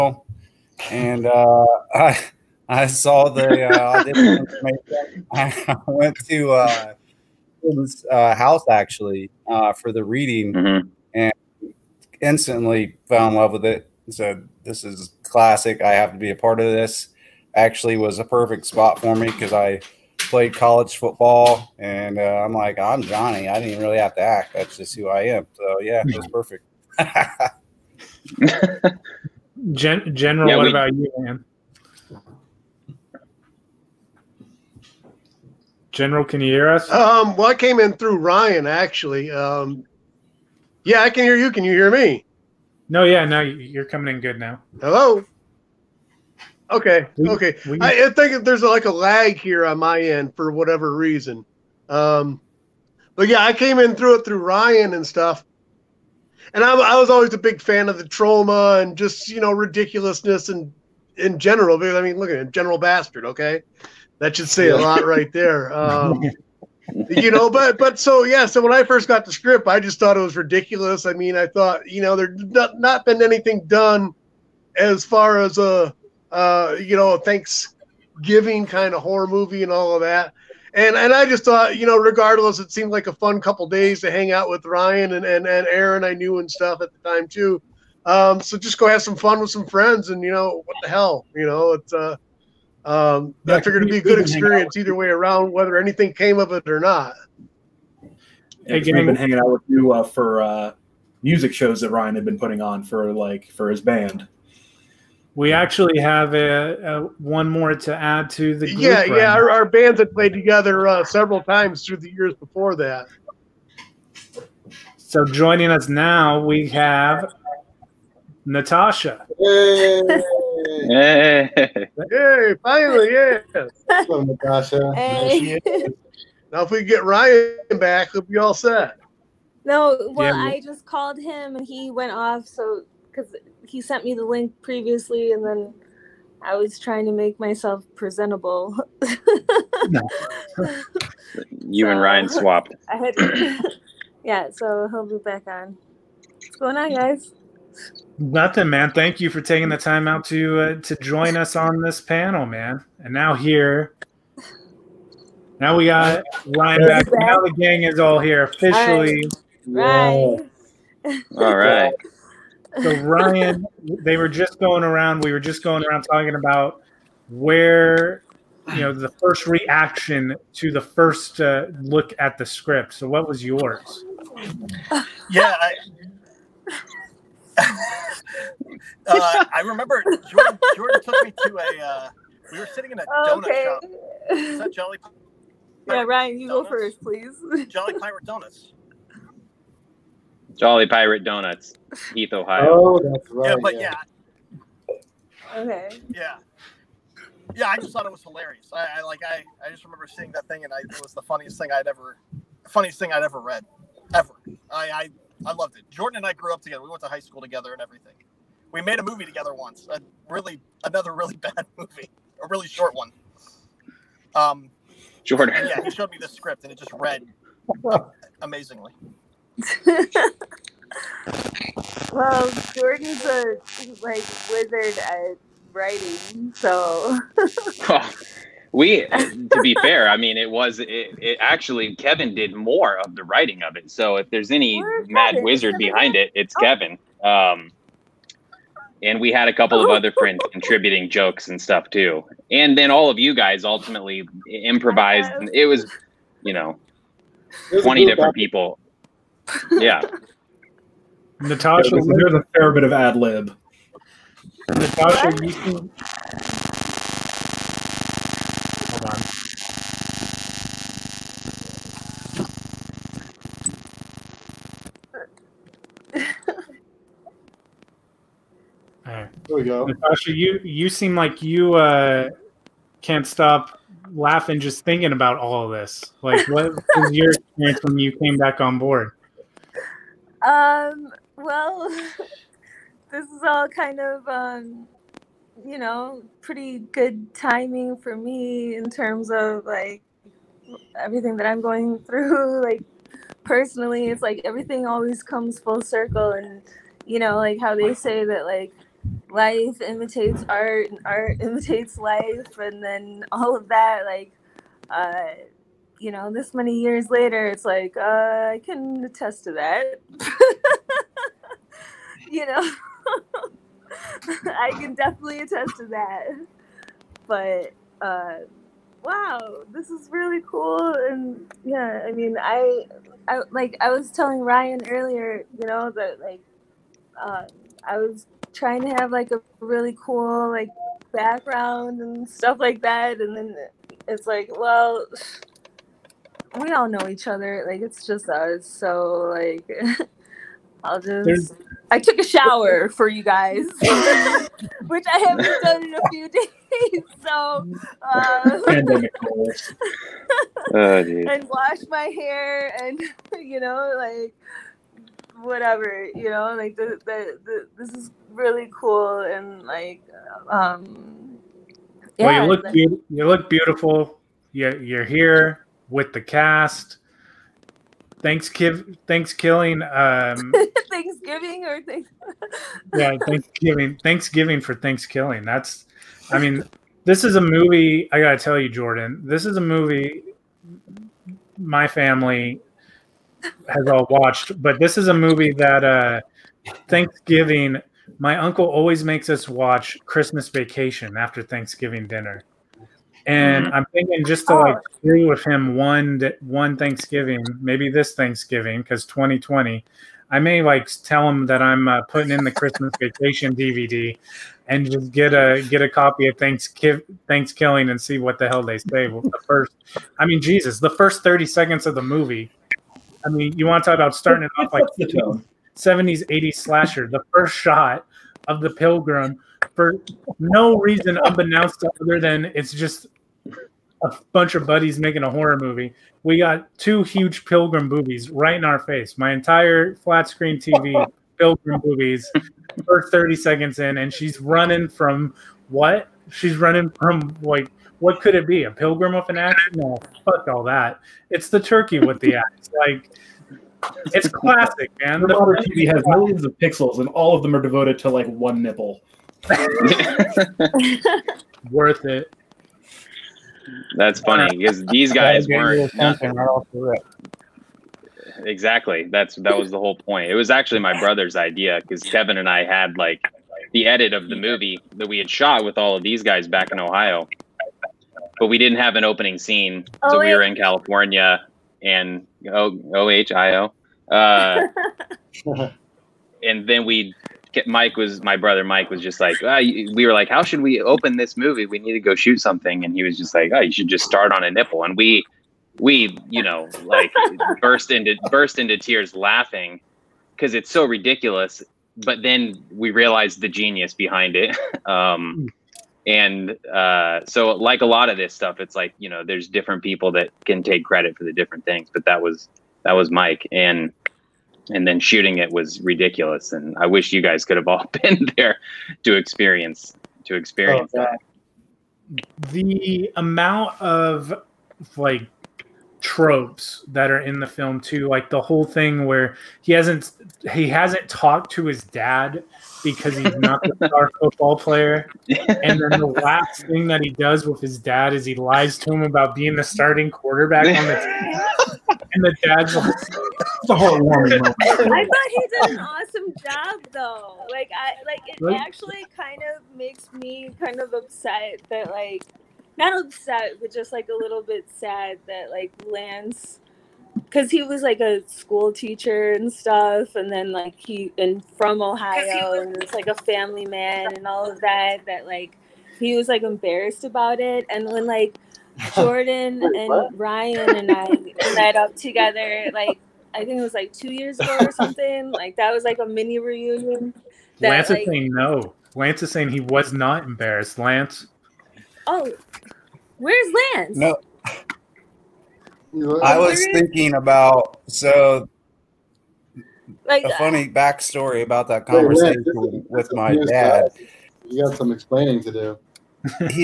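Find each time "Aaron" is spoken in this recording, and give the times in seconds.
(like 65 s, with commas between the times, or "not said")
85 s.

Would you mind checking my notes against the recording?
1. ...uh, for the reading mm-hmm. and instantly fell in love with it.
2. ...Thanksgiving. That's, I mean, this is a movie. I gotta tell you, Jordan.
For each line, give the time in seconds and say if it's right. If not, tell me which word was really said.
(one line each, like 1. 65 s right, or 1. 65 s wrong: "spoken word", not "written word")
1. 9 s right
2. 374 s right.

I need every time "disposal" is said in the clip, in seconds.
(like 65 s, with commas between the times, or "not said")
not said.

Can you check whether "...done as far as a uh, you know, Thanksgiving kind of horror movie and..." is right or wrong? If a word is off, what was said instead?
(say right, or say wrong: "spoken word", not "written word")
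right.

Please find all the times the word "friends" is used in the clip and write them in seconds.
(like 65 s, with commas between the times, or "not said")
89 s, 240 s.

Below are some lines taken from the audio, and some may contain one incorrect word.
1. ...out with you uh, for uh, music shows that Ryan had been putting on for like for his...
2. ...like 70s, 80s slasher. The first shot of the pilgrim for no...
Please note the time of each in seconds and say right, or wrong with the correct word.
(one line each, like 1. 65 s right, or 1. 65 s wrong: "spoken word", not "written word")
1. 99 s right
2. 414 s right.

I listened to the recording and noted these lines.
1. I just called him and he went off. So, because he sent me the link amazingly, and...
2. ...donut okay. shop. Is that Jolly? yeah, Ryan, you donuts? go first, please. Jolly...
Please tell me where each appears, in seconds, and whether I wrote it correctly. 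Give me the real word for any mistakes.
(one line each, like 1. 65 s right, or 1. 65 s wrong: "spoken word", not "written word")
1. 130 s wrong: "previously", not "amazingly"
2. 183 s right.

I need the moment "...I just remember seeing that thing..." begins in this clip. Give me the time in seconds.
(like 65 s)
199 s.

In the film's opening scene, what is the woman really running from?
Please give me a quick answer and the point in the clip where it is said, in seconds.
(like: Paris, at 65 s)
The turkey with the axe, at 441 s.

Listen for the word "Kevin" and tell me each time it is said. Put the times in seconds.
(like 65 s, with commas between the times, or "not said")
231 s, 236 s, 462 s.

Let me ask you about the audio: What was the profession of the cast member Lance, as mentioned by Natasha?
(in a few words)
School teacher.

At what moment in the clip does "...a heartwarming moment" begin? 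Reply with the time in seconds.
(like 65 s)
533 s.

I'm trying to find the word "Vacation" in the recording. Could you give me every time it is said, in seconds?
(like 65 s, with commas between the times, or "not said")
390 s, 403 s.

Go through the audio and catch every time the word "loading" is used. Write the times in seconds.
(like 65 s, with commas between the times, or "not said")
not said.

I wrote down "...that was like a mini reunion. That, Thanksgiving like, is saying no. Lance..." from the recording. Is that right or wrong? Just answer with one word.
wrong.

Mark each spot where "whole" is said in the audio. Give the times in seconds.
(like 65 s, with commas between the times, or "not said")
459 s, 518 s.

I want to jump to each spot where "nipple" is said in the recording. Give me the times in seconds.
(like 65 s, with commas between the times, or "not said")
448 s, 484 s.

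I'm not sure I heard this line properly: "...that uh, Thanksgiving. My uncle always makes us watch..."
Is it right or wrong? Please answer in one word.
right.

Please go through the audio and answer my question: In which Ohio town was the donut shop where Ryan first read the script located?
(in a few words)
Heath.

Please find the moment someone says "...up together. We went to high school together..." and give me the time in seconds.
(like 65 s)
206 s.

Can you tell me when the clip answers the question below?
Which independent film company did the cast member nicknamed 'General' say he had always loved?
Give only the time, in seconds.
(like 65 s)
58 s.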